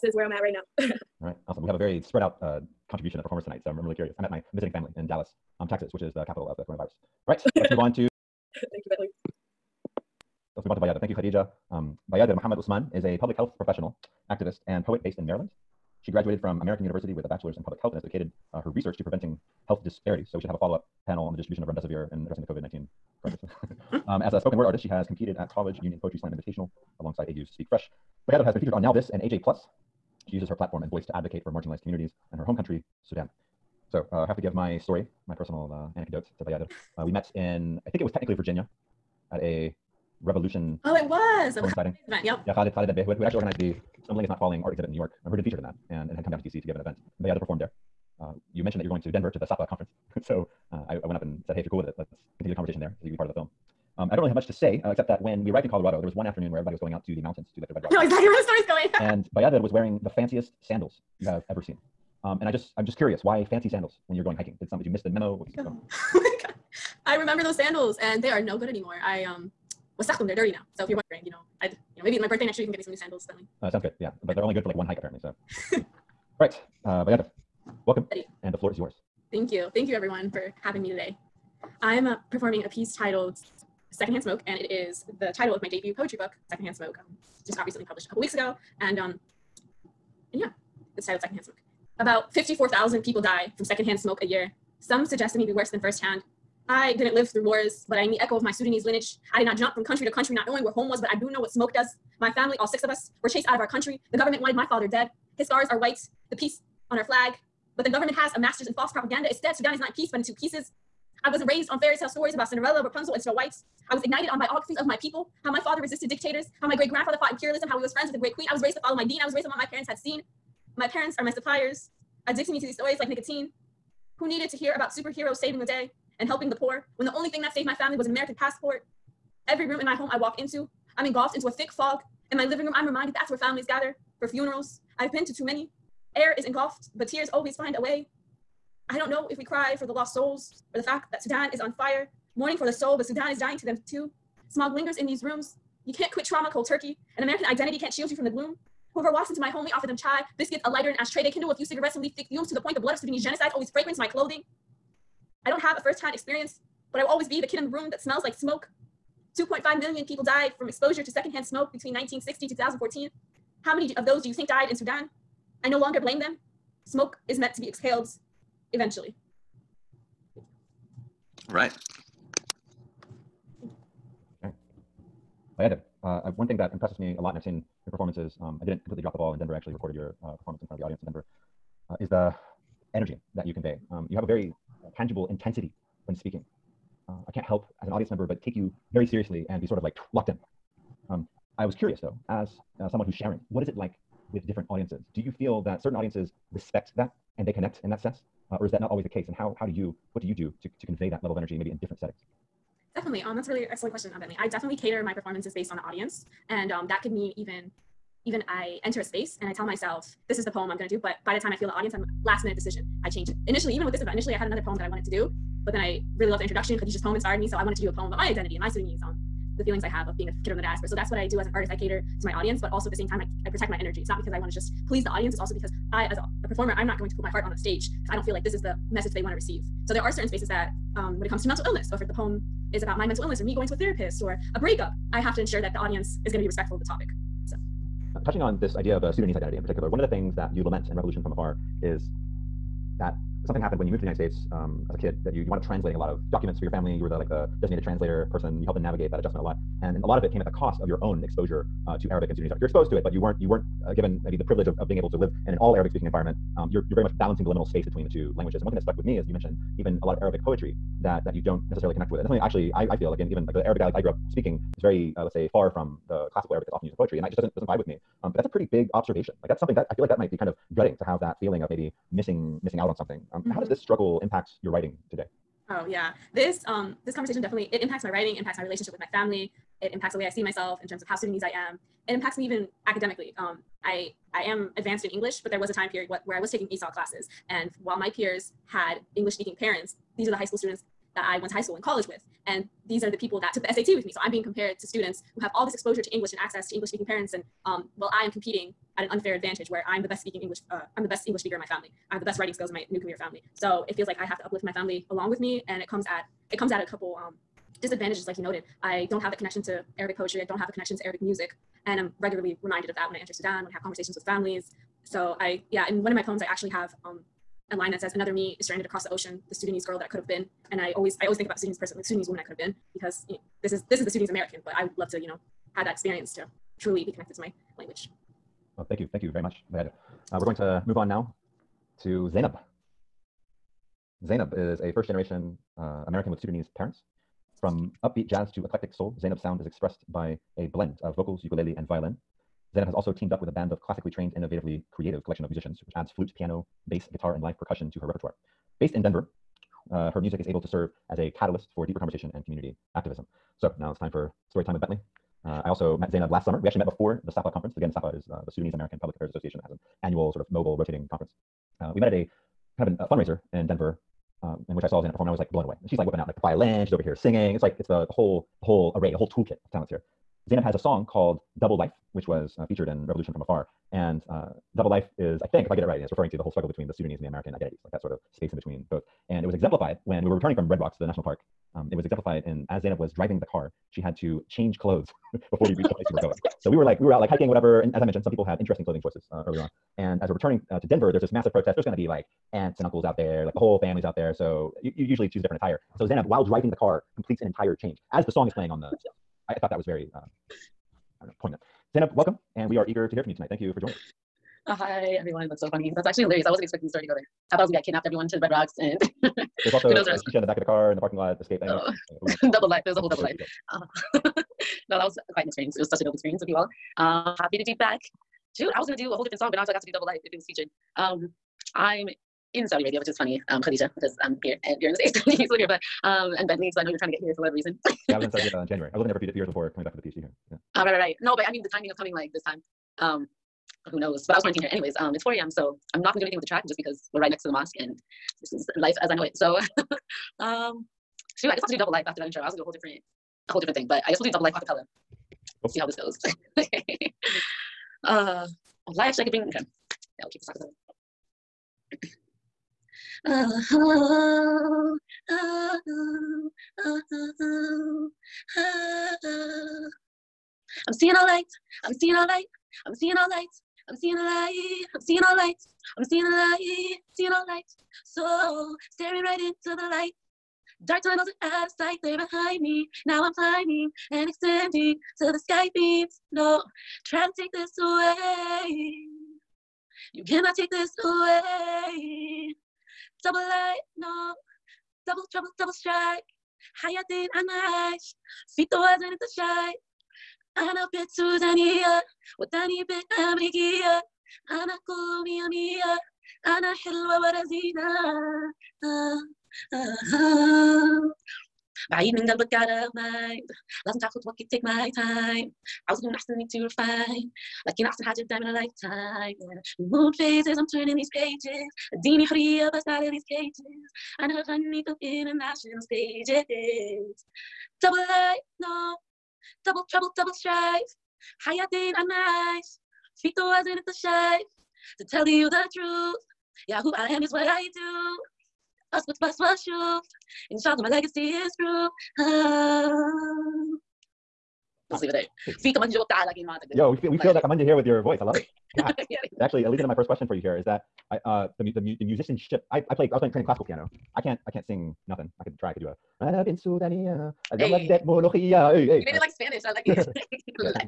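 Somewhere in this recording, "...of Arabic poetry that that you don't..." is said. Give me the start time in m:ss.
4:20.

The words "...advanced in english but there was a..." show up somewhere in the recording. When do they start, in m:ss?
4:44.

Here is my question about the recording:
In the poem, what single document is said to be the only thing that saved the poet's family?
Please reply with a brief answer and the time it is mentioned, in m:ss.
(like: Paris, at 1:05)
American passport, at 2:08.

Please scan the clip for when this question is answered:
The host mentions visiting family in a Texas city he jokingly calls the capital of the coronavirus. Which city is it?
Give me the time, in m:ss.
0:05.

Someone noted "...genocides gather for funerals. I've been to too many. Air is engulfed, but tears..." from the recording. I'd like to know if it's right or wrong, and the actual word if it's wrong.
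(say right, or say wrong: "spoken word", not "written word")
wrong: "families", not "genocides".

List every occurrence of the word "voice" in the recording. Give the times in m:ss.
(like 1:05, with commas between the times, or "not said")
0:30, 8:58.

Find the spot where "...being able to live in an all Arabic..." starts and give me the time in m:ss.
4:14.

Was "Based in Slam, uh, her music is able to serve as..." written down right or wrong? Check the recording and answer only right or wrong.
wrong.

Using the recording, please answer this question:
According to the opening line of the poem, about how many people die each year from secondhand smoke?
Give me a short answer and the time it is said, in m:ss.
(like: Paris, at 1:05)
54,000, at 1:32.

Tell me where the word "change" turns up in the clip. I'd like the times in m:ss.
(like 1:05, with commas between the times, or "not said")
3:33, 6:24, 6:37.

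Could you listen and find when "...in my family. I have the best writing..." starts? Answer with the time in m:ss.
5:01.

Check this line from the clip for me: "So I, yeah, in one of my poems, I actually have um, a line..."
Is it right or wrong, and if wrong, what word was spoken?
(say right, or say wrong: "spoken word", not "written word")
right.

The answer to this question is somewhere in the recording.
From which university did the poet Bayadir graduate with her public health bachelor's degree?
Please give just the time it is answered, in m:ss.
0:16.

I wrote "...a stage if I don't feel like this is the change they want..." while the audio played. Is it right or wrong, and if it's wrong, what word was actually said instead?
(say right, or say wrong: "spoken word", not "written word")
wrong: "message", not "change".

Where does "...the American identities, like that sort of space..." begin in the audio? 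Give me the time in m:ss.
6:17.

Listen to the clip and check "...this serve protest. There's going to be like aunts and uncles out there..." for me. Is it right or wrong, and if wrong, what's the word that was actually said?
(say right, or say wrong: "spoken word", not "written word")
wrong: "massive", not "serve".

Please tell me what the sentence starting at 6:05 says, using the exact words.
She's like whipping out like the violin.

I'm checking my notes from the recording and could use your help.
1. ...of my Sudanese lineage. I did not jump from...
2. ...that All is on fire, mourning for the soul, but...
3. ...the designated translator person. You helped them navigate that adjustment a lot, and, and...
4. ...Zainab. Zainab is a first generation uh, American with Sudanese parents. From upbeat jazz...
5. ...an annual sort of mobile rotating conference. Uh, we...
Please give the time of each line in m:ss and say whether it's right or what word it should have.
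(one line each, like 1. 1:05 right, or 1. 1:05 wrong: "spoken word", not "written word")
1. 1:38 right
2. 2:21 wrong: "Sudan", not "All"
3. 4:07 right
4. 5:32 right
5. 5:59 right.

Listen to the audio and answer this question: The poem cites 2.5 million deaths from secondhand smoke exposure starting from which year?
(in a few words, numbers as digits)
1960.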